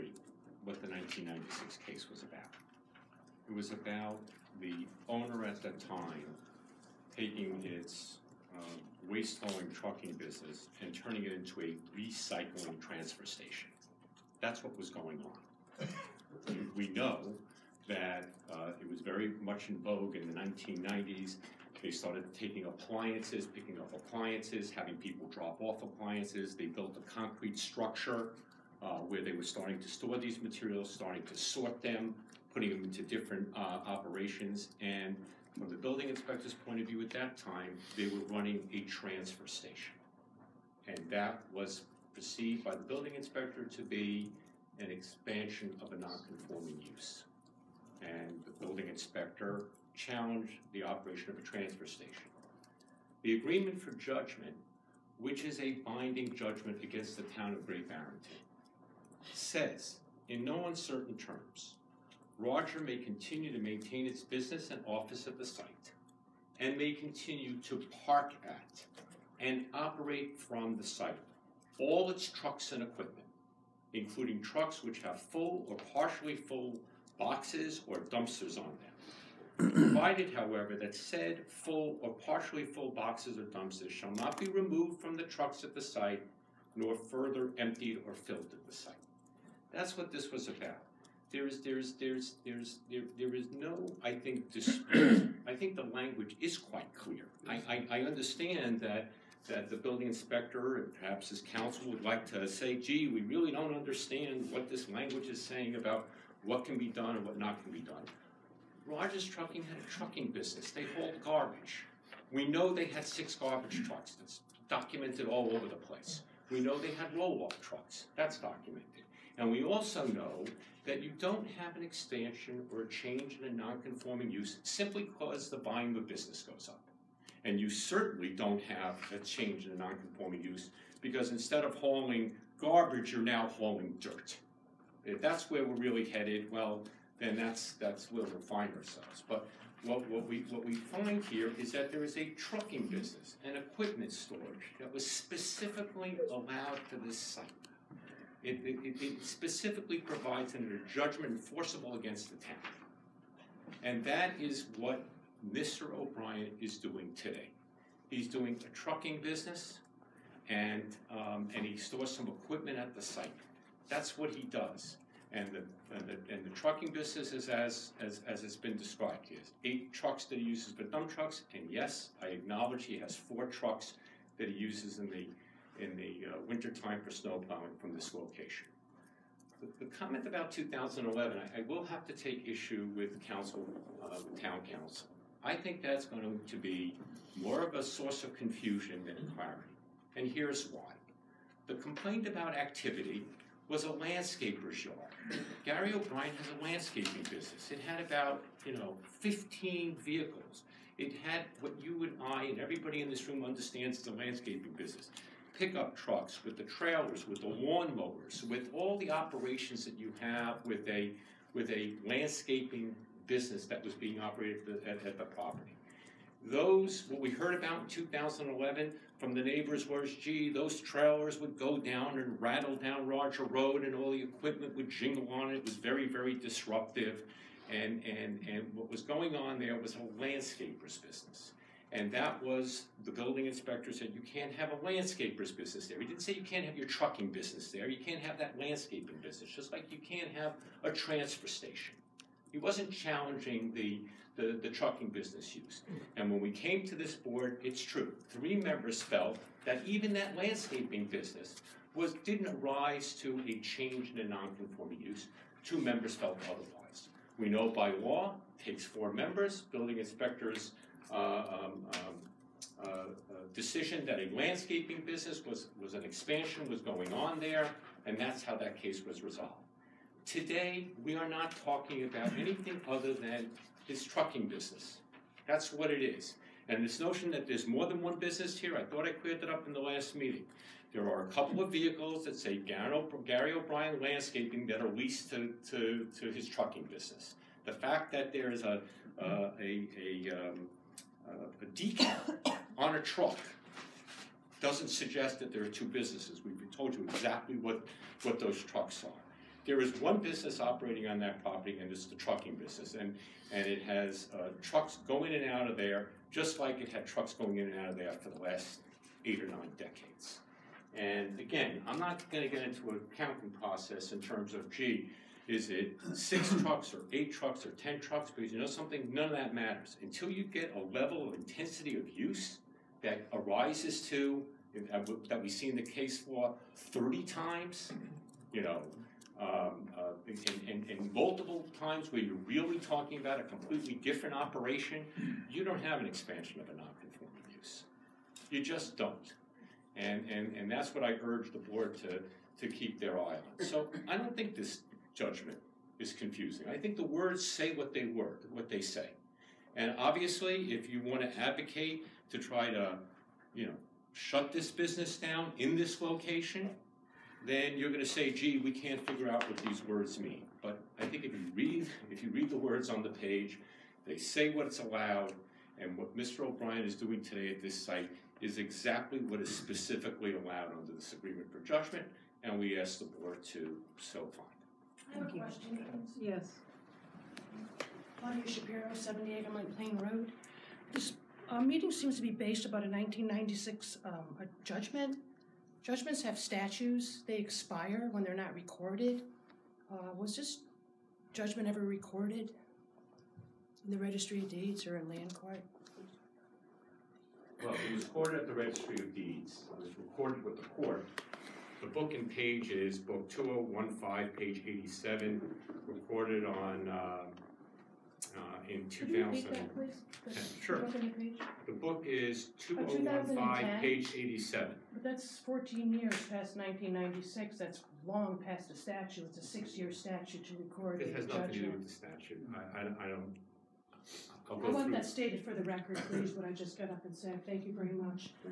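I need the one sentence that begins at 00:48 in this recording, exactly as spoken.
And the building inspector challenged the operation of a transfer station.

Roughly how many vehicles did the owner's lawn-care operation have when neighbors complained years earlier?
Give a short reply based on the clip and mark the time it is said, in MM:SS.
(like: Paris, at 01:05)
15, at 03:19.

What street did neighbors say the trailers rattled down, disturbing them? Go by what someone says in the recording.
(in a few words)
Roger Road.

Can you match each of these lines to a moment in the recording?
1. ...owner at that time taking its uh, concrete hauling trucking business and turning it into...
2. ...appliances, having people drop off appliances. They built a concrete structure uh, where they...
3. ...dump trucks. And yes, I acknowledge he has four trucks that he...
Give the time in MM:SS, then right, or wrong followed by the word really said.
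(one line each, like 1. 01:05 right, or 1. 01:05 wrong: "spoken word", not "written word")
1. 00:05 wrong: "waste", not "concrete"
2. 00:23 right
3. 02:50 right.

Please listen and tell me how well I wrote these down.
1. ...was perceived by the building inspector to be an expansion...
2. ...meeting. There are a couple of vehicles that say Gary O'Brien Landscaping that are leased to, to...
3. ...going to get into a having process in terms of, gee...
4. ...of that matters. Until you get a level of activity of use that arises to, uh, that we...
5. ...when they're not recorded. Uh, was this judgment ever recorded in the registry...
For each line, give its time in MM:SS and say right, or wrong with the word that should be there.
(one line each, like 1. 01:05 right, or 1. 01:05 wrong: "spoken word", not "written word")
1. 00:41 right
2. 04:40 right
3. 05:12 wrong: "accounting", not "having"
4. 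05:19 wrong: "intensity", not "activity"
5. 06:28 right.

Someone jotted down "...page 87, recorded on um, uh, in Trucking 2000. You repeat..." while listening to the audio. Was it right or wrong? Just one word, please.
wrong.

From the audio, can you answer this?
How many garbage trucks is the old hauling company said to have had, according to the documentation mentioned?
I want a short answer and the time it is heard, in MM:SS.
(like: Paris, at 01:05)
6, at 01:53.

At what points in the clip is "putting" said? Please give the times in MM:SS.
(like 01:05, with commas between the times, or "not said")
00:32.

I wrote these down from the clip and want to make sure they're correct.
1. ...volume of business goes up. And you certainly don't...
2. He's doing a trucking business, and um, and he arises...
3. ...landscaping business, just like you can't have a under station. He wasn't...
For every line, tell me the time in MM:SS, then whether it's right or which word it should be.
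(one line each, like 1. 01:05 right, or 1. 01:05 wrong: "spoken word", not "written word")
1. 02:05 right
2. 02:38 wrong: "stores", not "arises"
3. 03:58 wrong: "transfer", not "under".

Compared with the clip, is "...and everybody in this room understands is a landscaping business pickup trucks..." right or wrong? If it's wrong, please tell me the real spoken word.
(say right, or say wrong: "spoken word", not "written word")
right.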